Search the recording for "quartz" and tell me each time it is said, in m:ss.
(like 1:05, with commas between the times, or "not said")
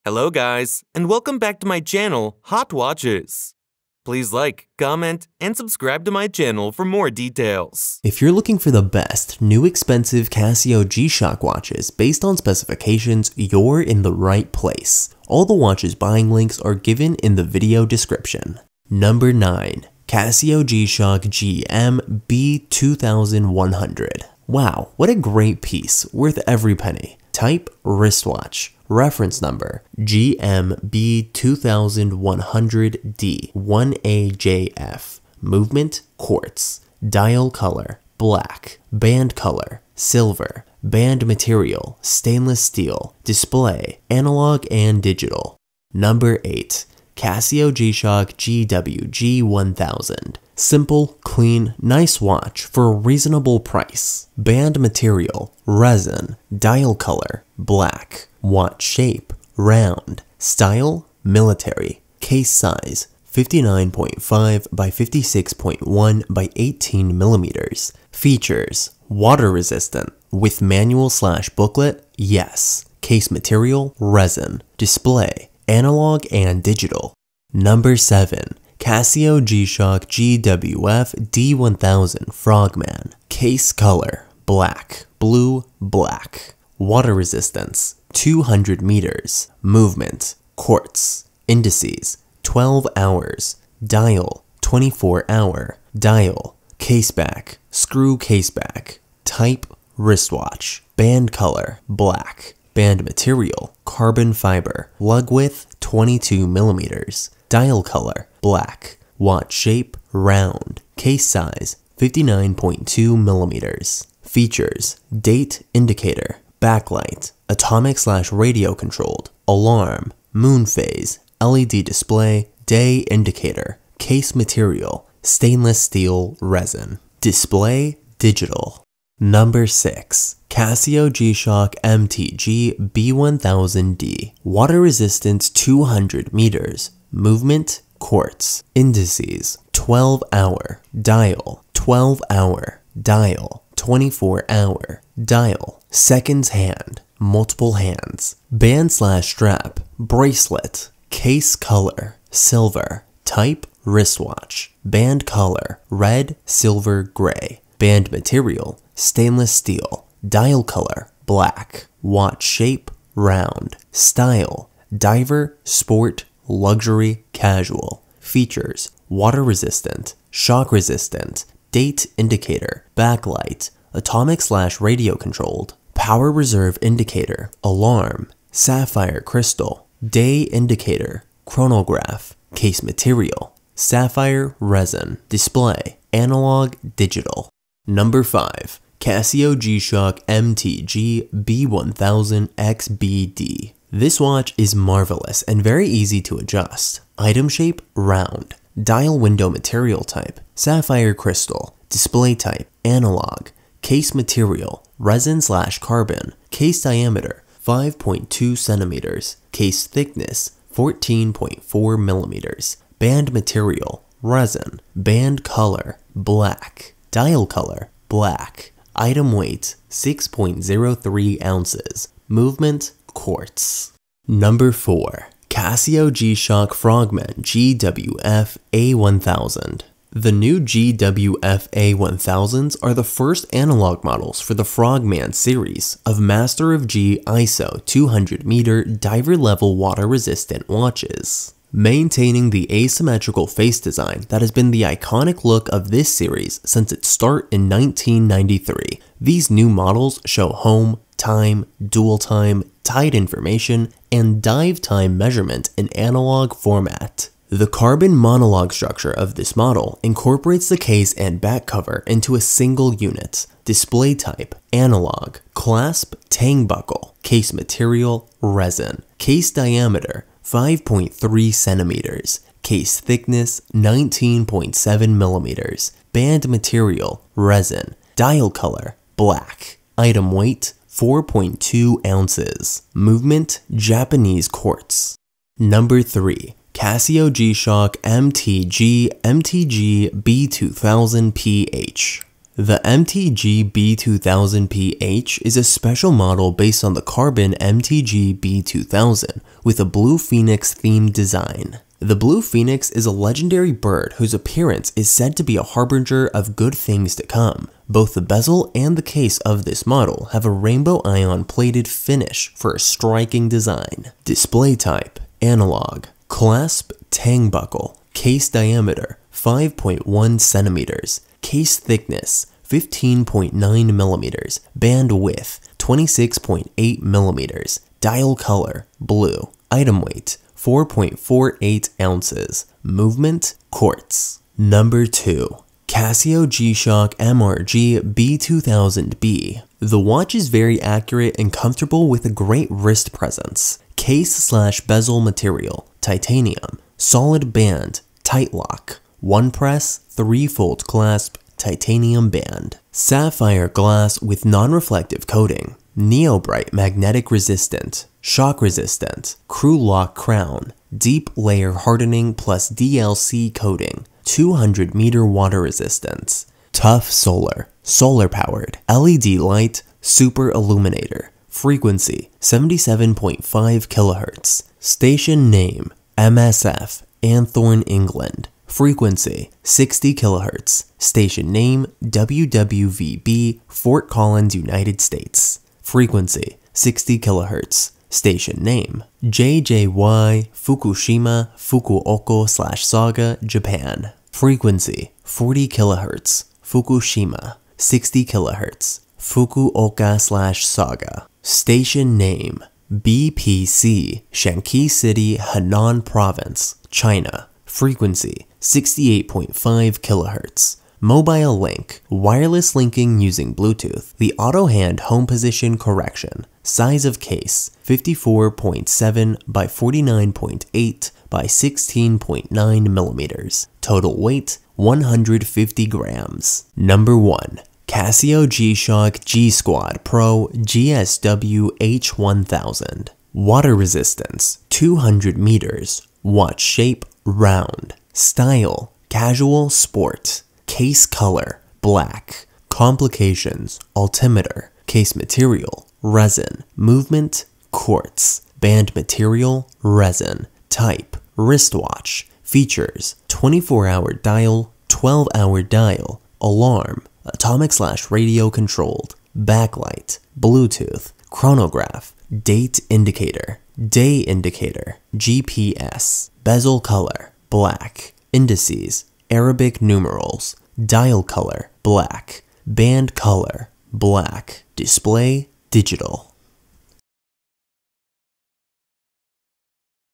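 0:36, 1:30, 2:18, 3:43, 4:44, 5:33, 7:27.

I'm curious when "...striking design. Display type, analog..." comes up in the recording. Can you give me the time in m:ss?
5:12.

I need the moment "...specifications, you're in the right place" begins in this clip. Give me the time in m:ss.
0:12.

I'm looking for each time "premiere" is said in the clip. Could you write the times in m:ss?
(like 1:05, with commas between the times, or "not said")
not said.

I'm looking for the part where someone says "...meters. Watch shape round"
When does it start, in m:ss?
7:15.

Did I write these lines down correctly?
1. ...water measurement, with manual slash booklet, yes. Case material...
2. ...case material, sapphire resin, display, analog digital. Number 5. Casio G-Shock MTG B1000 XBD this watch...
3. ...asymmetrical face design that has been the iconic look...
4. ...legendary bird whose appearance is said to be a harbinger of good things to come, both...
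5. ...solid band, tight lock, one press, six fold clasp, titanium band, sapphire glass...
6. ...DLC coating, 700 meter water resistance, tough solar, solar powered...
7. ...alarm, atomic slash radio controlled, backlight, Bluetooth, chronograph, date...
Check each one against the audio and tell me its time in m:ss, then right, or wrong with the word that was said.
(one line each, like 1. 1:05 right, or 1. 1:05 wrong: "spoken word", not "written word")
1. 1:09 wrong: "resistant", not "measurement"
2. 3:02 right
3. 4:02 right
4. 5:03 right
5. 5:46 wrong: "three", not "six"
6. 6:02 wrong: "200", not "700"
7. 7:36 right.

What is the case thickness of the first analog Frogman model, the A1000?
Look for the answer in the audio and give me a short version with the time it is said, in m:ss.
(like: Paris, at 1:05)
19.7 millimeters, at 4:33.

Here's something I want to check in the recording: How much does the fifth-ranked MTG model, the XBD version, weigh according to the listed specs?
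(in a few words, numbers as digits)
6.03 ounces.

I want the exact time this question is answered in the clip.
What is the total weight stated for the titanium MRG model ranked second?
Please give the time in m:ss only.
7:04.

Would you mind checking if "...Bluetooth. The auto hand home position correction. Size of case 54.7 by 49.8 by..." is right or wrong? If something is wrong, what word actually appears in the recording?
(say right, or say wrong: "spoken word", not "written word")
right.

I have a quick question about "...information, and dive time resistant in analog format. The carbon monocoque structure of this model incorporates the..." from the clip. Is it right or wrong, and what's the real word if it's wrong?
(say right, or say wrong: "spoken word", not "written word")
wrong: "measurement", not "resistant".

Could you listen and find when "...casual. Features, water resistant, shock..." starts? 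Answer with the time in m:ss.
2:47.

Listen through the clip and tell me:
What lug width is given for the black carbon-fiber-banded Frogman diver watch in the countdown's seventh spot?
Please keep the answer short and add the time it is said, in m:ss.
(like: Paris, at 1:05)
22 millimeters, at 1:45.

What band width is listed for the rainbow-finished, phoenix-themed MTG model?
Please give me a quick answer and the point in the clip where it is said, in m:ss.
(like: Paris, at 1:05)
26.8 millimeters, at 5:25.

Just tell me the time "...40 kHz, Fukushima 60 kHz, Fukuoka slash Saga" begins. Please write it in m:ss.
6:35.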